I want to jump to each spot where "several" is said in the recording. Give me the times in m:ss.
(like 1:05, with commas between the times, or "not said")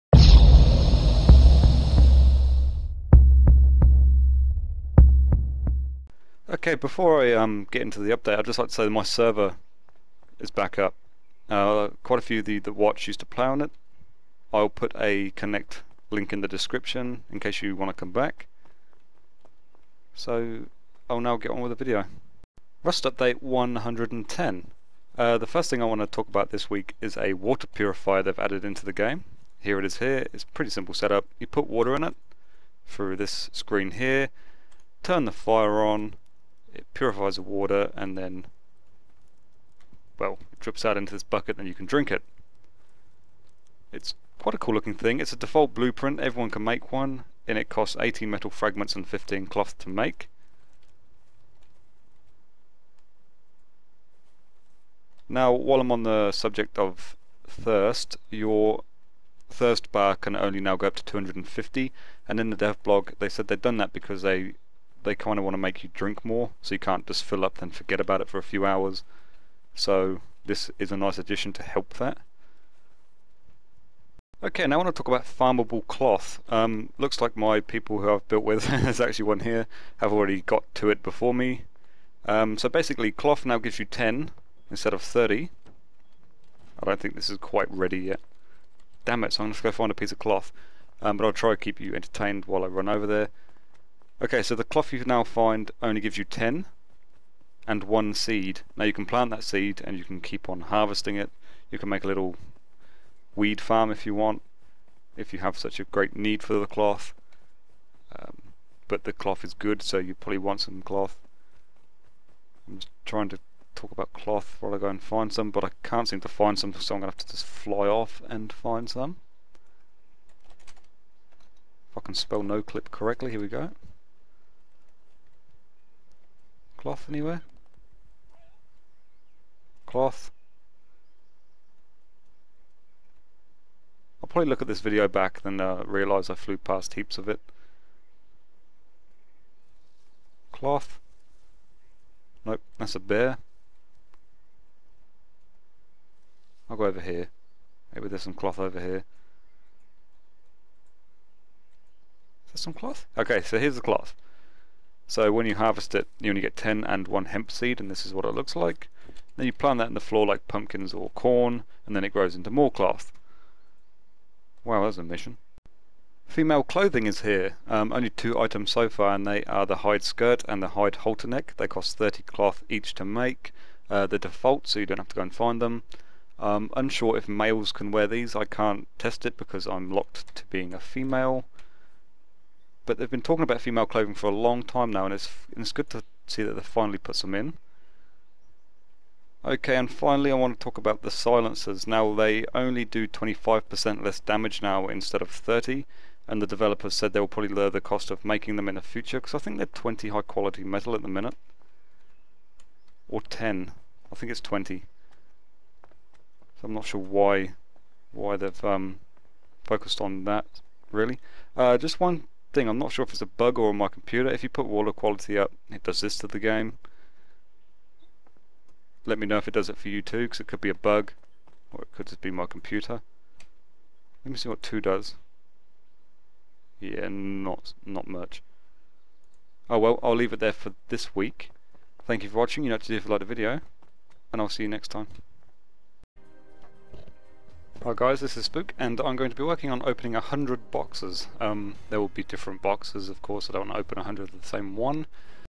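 not said.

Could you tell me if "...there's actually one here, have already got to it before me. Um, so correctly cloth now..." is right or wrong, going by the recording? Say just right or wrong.
wrong.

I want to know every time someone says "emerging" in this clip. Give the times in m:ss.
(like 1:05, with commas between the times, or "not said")
not said.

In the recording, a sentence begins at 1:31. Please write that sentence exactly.
Um, but I'll try to keep you entertained while I run over there.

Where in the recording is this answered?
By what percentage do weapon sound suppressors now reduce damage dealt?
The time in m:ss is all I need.
3:13.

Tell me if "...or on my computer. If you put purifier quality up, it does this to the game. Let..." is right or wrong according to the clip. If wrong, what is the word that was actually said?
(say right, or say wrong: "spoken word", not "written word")
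wrong: "water", not "purifier".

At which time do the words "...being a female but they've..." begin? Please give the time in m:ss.
3:00.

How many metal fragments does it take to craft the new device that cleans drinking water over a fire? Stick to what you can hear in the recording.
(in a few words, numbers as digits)
18.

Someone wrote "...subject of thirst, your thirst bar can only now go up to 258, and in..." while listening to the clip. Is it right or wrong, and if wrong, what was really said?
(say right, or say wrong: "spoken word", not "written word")
wrong: "250", not "258".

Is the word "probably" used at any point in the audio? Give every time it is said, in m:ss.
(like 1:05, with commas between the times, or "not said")
1:50, 2:14, 3:17.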